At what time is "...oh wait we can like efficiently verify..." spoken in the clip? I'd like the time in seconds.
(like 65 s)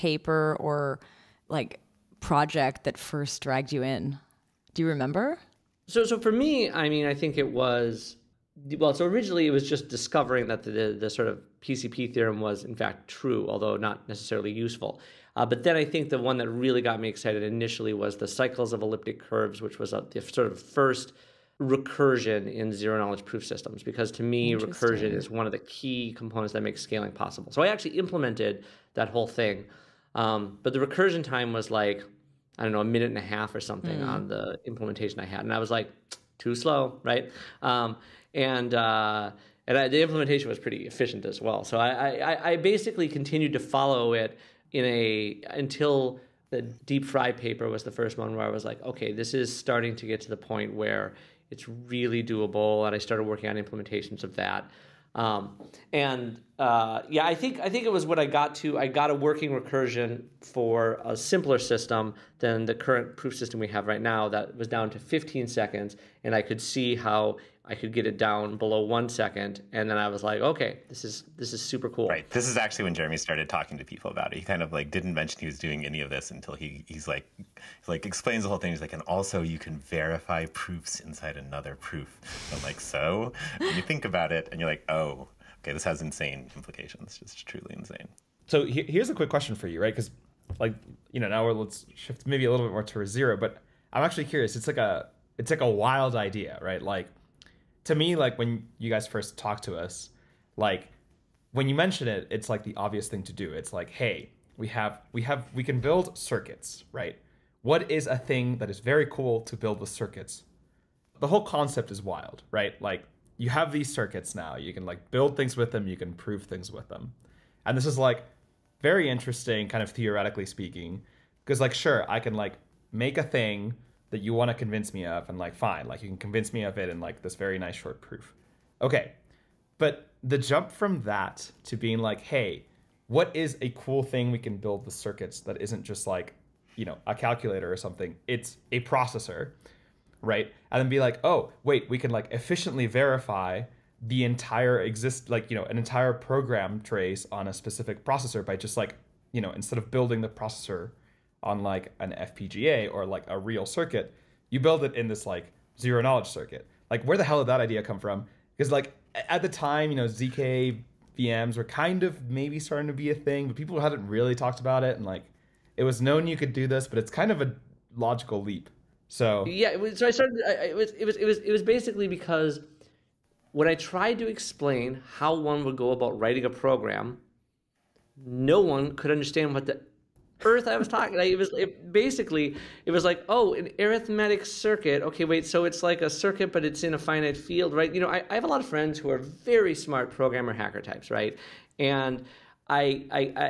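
141 s.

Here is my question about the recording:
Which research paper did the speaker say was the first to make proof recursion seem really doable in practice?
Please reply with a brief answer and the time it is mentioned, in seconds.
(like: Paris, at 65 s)
DEEP-FRI, at 46 s.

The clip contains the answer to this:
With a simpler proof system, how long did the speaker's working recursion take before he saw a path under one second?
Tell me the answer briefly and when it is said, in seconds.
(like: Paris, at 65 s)
15 seconds, at 65 s.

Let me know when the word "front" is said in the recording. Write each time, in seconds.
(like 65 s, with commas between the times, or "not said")
not said.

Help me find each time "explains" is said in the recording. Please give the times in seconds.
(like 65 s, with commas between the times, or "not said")
78 s, 174 s.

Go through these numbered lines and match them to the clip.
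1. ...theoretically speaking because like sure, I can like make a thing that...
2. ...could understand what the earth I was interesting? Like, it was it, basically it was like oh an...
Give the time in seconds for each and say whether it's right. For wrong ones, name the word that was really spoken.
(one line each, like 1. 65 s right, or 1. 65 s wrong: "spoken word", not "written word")
1. 119 s right
2. 178 s wrong: "talking", not "interesting".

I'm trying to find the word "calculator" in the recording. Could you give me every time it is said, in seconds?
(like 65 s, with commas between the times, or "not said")
137 s.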